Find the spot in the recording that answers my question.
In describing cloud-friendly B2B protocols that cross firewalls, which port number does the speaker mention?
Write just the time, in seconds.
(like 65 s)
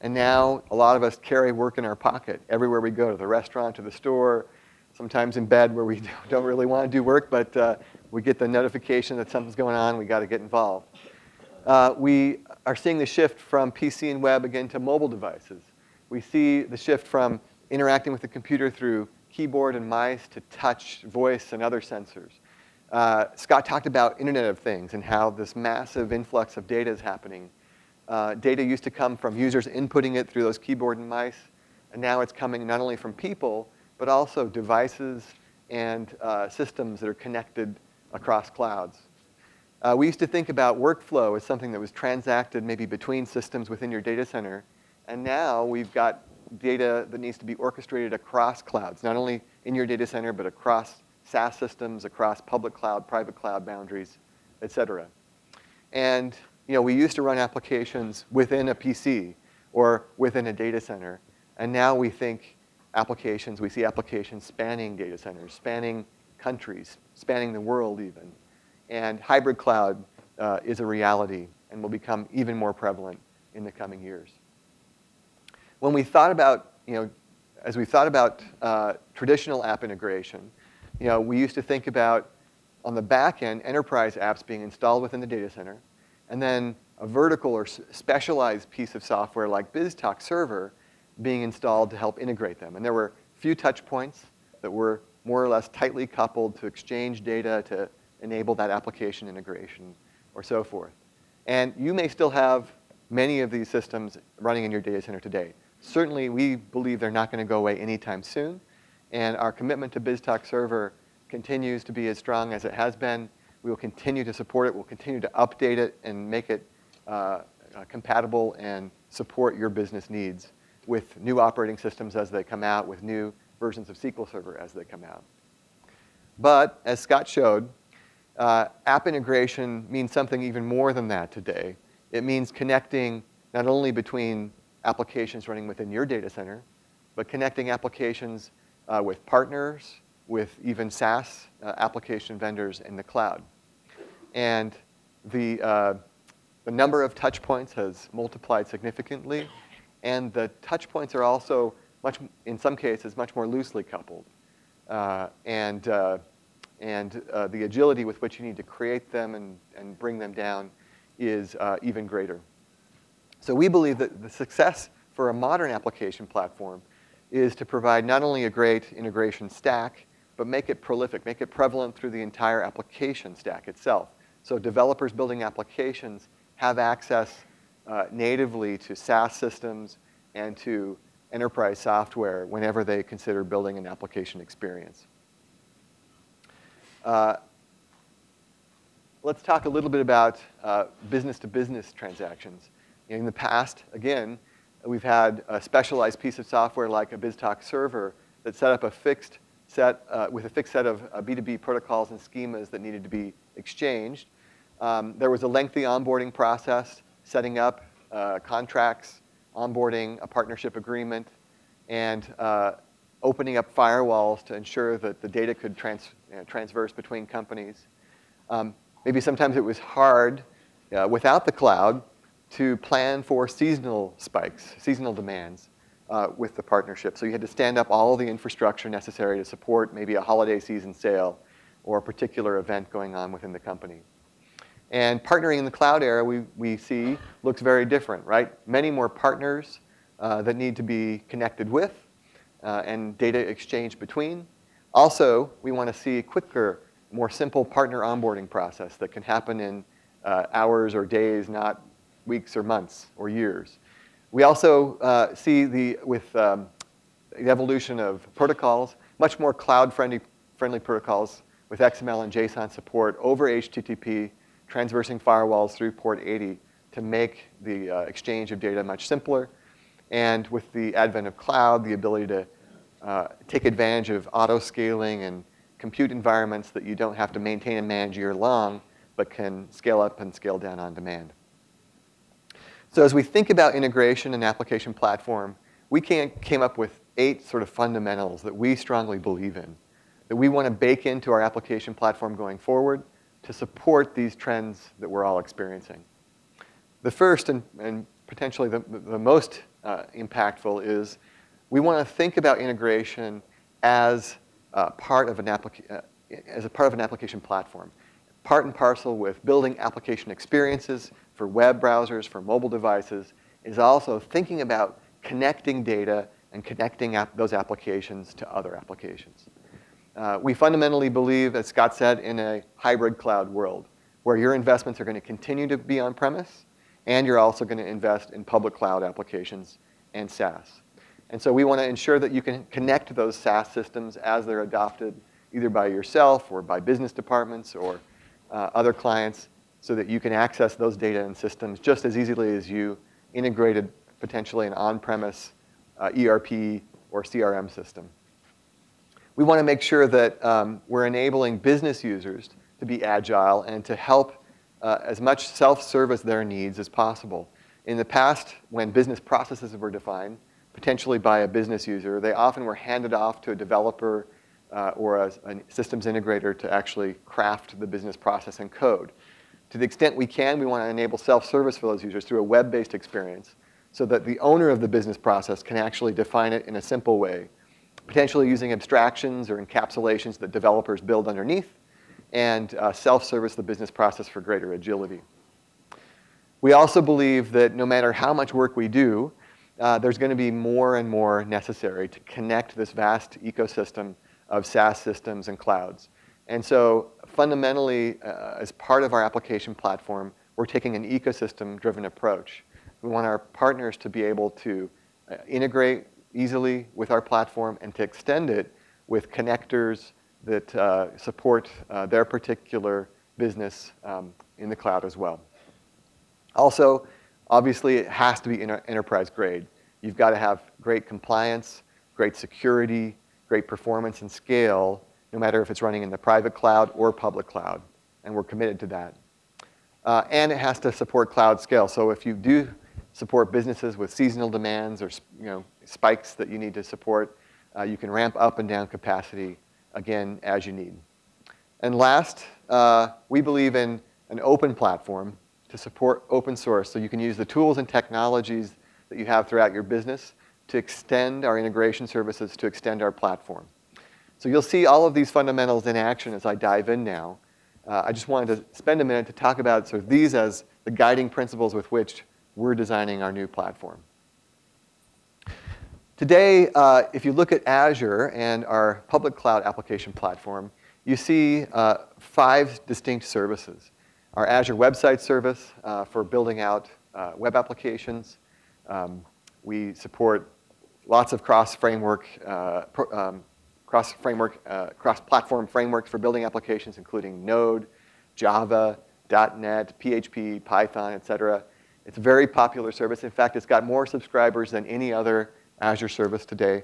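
265 s.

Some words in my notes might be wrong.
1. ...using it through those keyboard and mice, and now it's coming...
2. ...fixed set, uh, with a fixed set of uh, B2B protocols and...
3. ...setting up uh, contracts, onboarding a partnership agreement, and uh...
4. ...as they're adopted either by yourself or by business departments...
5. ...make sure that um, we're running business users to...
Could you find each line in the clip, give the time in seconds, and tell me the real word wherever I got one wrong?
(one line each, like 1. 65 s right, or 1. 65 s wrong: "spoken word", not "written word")
1. 29 s wrong: "inputting", not "using"
2. 198 s right
3. 207 s right
4. 334 s right
5. 349 s wrong: "enabling", not "running".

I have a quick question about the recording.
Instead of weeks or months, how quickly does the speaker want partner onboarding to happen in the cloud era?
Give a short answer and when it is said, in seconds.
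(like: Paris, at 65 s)
hours or days, at 250 s.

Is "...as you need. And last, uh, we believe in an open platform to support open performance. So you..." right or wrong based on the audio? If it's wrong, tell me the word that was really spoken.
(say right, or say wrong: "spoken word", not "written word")
wrong: "source", not "performance".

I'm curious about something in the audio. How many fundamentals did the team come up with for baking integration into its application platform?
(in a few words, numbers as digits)
8.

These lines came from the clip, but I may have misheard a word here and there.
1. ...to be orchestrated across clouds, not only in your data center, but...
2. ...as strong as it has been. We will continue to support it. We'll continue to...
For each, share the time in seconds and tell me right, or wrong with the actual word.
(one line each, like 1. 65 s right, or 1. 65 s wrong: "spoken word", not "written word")
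1. 47 s right
2. 112 s right.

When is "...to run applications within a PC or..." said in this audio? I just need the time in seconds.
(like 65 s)
57 s.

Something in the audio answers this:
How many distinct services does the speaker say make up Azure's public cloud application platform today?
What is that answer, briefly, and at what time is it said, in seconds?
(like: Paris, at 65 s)
5, at 472 s.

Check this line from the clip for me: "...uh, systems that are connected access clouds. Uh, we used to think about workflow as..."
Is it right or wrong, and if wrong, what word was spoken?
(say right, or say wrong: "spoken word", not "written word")
wrong: "across", not "access".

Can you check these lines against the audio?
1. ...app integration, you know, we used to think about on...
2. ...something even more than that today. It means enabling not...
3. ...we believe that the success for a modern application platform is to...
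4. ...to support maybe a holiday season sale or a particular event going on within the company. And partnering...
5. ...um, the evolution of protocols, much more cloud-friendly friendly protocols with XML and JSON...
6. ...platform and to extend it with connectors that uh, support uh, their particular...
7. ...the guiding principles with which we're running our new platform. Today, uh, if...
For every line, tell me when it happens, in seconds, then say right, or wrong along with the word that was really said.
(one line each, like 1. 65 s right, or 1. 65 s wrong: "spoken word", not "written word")
1. 79 s right
2. 130 s wrong: "connecting", not "enabling"
3. 163 s right
4. 229 s right
5. 256 s right
6. 407 s right
7. 460 s wrong: "designing", not "running".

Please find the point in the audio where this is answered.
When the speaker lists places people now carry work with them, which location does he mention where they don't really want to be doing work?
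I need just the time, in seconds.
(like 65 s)
5 s.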